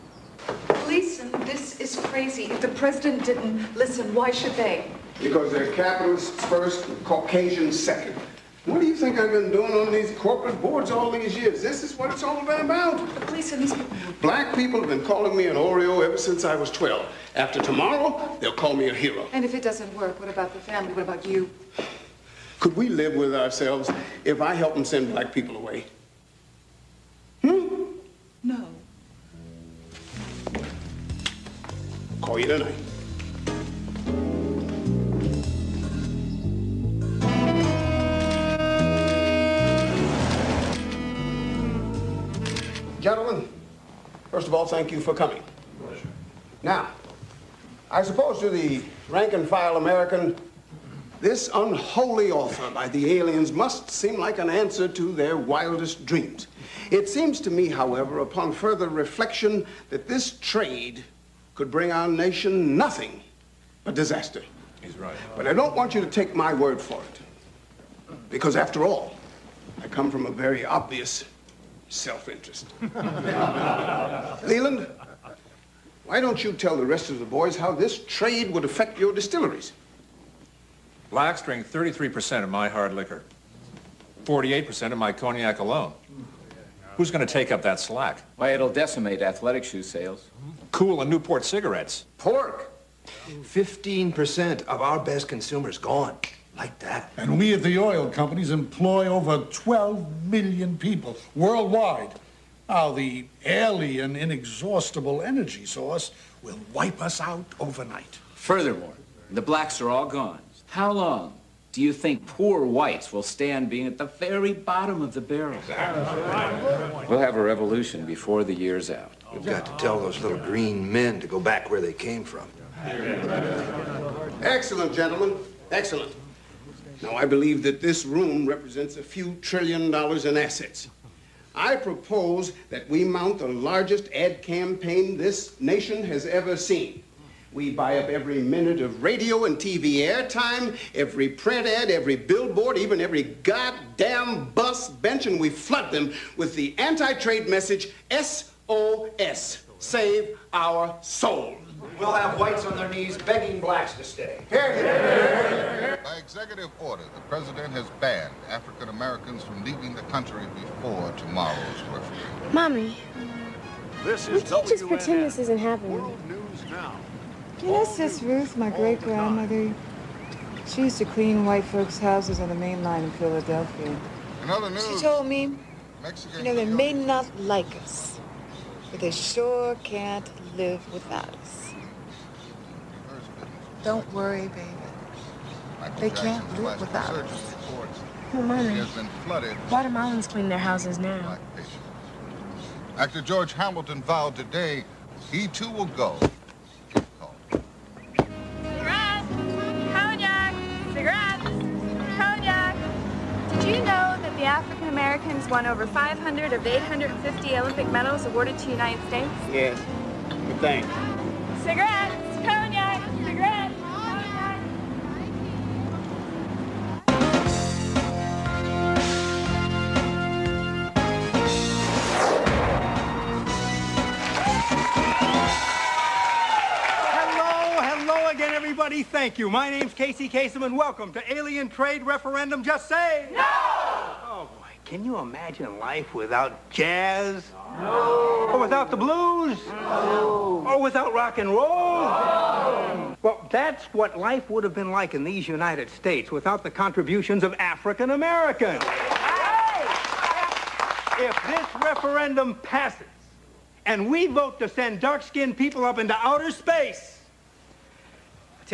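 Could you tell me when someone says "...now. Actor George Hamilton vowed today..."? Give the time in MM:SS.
03:10.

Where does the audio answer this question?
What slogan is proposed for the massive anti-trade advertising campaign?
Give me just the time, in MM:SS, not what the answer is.
02:29.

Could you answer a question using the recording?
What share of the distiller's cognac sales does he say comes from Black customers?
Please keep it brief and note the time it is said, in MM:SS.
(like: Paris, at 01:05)
48%, at 01:24.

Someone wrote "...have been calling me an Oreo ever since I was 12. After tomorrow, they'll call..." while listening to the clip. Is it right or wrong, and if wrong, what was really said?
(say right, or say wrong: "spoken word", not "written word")
right.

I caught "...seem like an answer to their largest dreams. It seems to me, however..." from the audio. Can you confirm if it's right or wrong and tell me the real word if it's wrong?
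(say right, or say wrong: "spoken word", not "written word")
wrong: "wildest", not "largest".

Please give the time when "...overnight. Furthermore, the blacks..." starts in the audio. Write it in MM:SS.
01:47.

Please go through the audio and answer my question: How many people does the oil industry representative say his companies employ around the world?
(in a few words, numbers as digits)
12 million.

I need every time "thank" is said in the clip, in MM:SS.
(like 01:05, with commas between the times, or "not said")
00:44, 03:49.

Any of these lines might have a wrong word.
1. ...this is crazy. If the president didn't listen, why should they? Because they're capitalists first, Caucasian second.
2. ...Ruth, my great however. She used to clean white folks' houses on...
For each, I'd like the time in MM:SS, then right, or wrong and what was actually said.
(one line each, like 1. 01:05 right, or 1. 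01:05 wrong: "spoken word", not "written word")
1. 00:01 right
2. 02:48 wrong: "grandmother", not "however".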